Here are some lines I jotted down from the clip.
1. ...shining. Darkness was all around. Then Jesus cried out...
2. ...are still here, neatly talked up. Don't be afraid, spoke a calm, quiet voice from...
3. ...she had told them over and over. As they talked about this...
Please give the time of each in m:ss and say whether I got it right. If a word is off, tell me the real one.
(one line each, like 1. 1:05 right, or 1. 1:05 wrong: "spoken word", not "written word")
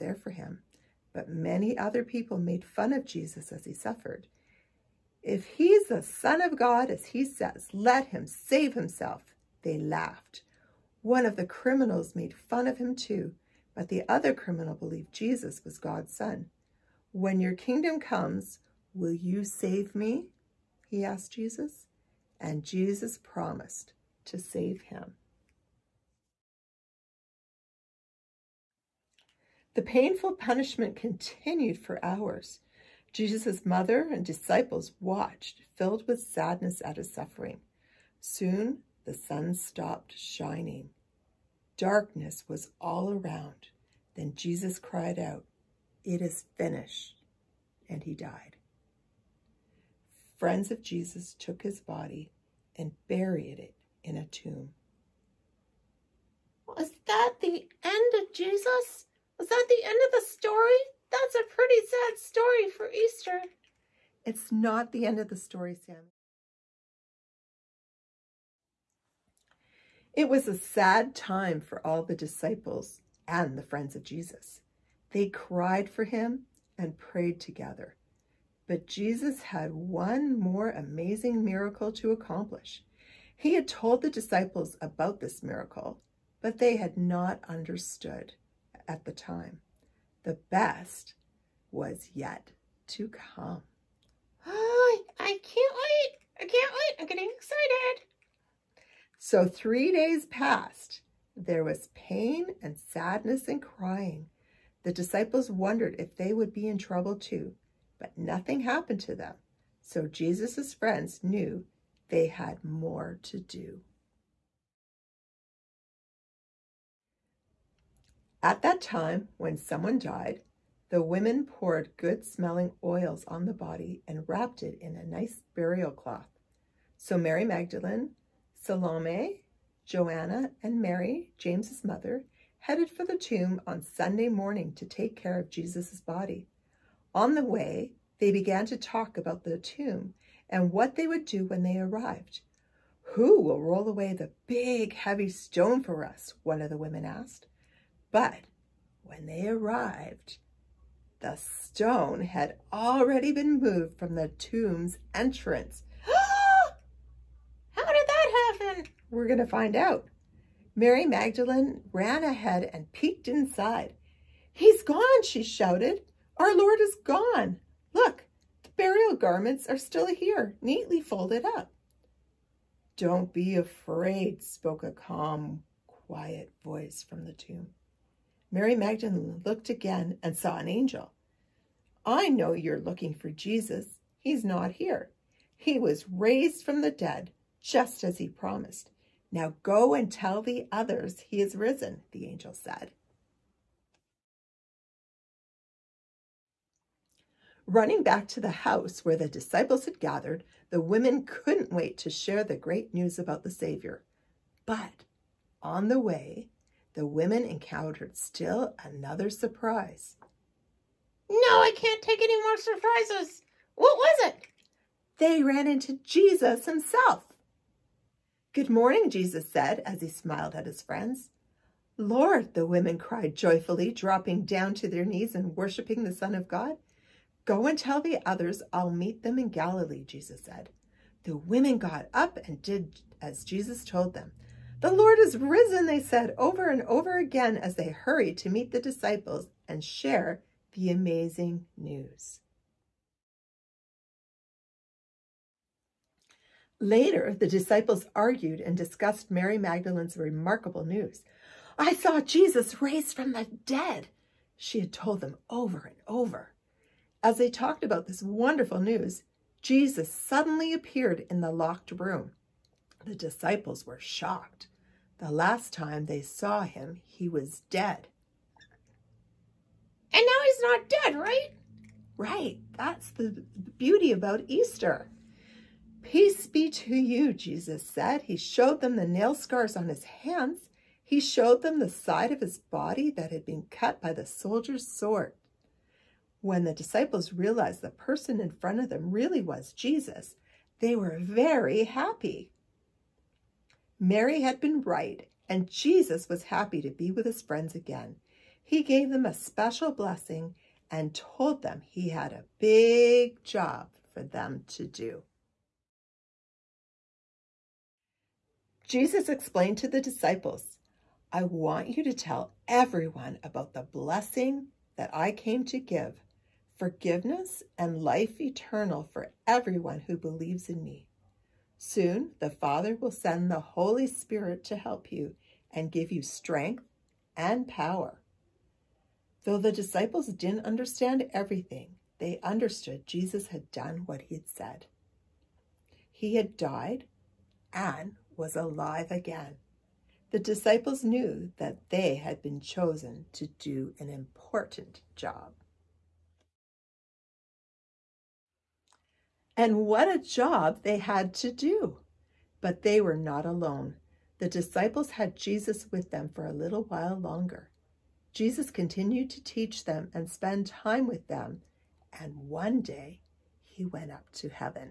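1. 0:40 right
2. 2:49 wrong: "folded", not "talked"
3. 4:14 right.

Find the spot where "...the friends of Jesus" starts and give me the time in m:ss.
1:13.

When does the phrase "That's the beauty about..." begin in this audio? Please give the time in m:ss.
4:32.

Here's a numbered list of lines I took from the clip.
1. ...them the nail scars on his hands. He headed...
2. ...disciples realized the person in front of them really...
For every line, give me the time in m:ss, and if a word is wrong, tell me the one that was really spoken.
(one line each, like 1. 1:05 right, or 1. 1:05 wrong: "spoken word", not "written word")
1. 4:38 wrong: "showed", not "headed"
2. 4:46 right.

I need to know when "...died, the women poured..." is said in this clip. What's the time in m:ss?
1:59.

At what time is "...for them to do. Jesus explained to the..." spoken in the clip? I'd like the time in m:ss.
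5:04.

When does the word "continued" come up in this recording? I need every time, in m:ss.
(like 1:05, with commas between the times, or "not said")
0:30, 5:58.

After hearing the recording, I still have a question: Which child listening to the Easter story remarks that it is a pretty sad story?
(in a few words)
Sam.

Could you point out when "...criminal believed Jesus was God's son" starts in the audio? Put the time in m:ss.
0:14.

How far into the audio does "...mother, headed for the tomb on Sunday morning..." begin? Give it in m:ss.
2:11.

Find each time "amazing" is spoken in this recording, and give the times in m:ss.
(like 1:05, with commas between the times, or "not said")
1:20, 4:00.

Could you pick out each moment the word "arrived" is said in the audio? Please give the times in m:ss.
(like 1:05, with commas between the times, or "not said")
2:21, 2:29.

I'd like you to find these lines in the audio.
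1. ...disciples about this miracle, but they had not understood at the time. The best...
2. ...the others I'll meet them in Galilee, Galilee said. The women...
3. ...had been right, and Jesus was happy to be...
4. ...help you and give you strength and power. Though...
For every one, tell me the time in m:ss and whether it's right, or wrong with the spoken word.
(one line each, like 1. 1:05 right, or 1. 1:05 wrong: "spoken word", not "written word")
1. 1:24 right
2. 3:47 wrong: "Jesus", not "Galilee"
3. 4:54 right
4. 5:24 right.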